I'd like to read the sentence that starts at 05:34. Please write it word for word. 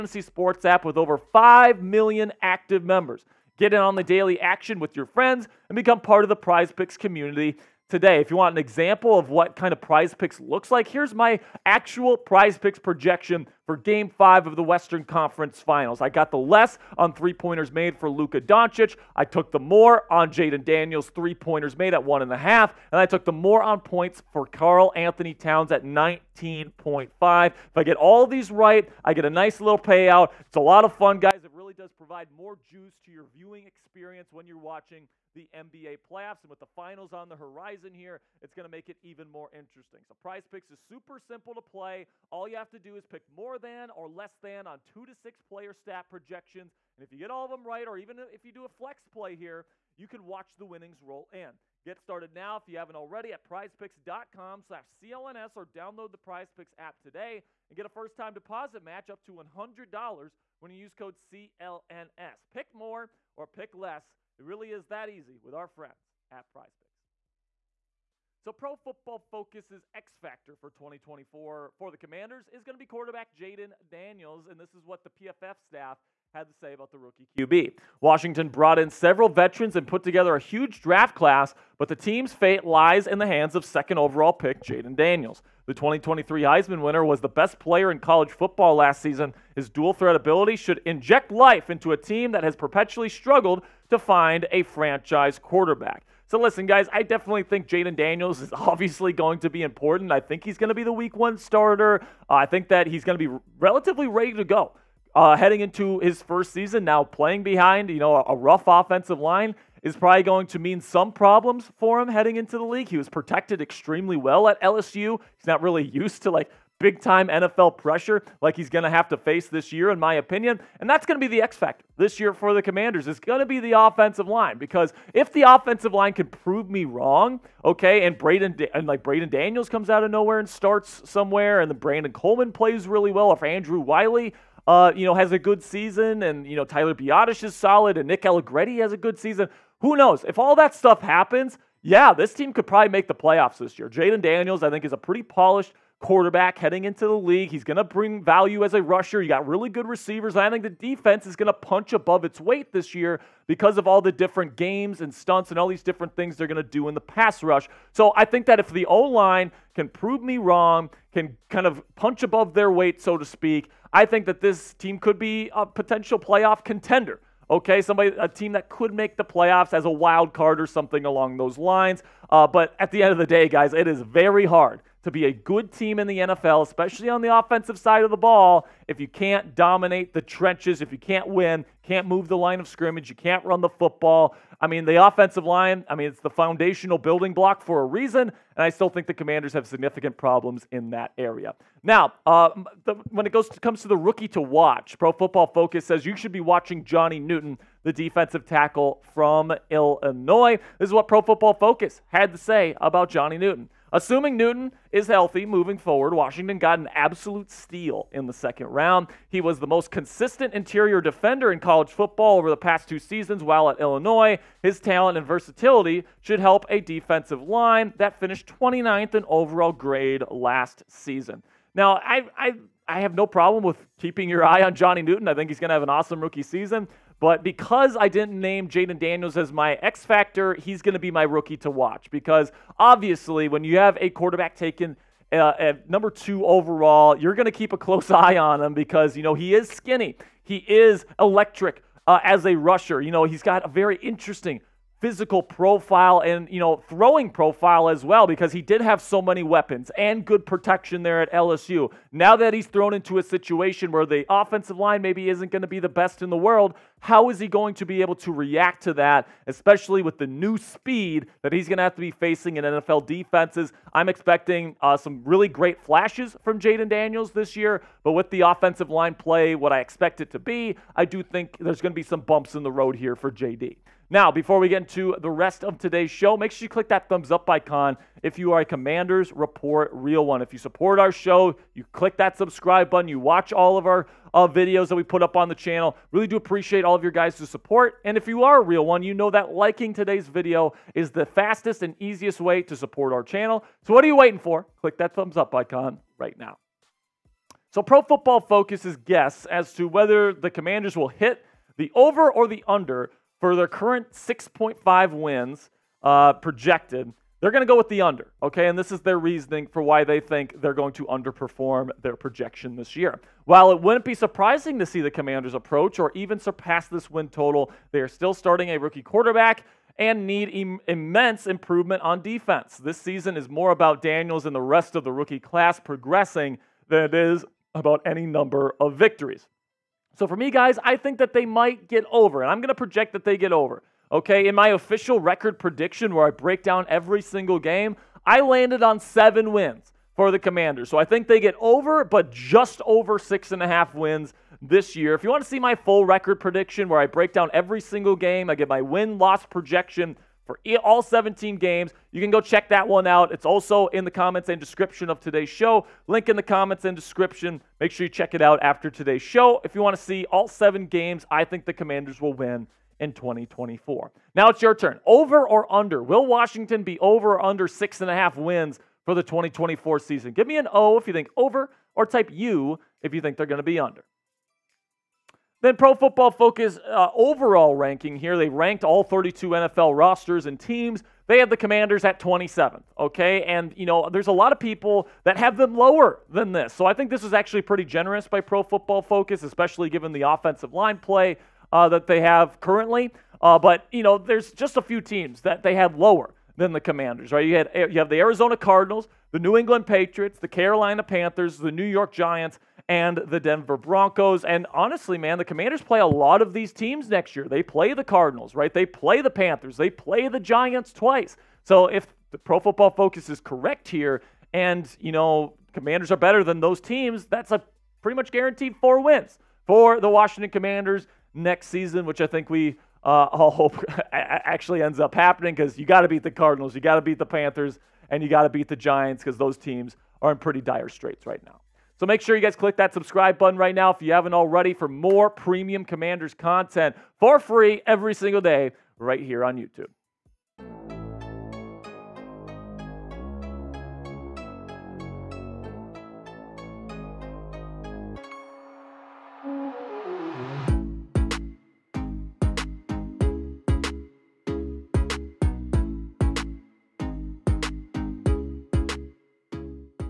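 Okay, in my official record prediction where I break down every single game, I landed on seven wins for the Commanders.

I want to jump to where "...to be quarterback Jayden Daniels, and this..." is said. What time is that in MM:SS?
01:12.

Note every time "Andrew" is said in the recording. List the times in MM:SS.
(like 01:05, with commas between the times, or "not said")
02:13.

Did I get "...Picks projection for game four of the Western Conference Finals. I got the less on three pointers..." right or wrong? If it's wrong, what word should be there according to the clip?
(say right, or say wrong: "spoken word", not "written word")
wrong: "five", not "four".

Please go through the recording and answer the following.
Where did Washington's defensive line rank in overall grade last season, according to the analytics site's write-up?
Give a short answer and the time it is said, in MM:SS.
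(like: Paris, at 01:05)
29th, at 03:38.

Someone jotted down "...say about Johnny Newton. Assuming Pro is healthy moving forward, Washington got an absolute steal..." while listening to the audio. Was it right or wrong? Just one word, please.
wrong.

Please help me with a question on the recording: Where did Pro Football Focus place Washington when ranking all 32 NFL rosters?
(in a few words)
27th.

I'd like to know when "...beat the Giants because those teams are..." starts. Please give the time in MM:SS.
07:08.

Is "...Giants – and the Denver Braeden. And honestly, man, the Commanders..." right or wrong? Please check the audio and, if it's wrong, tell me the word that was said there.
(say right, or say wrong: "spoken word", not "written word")
wrong: "Broncos", not "Braeden".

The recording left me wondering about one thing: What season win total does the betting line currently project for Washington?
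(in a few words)
6.5.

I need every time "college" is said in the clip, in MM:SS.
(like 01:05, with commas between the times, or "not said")
01:28, 03:31.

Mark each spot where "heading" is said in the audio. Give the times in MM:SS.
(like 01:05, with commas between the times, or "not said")
01:45, 01:52, 02:26.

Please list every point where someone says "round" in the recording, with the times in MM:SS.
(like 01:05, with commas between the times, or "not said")
03:28.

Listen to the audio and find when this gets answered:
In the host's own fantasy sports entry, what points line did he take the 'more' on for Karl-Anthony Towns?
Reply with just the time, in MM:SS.
00:25.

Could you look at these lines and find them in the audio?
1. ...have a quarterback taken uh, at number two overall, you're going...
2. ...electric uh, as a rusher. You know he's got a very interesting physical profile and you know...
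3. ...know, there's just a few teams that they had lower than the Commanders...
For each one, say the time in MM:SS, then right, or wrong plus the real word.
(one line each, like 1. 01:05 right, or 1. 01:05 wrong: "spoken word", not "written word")
1. 03:53 right
2. 04:01 right
3. 06:34 right.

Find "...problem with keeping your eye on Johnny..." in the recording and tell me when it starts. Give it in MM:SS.
03:43.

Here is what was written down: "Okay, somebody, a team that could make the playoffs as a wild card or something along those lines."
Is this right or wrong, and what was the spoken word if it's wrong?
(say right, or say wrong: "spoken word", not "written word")
right.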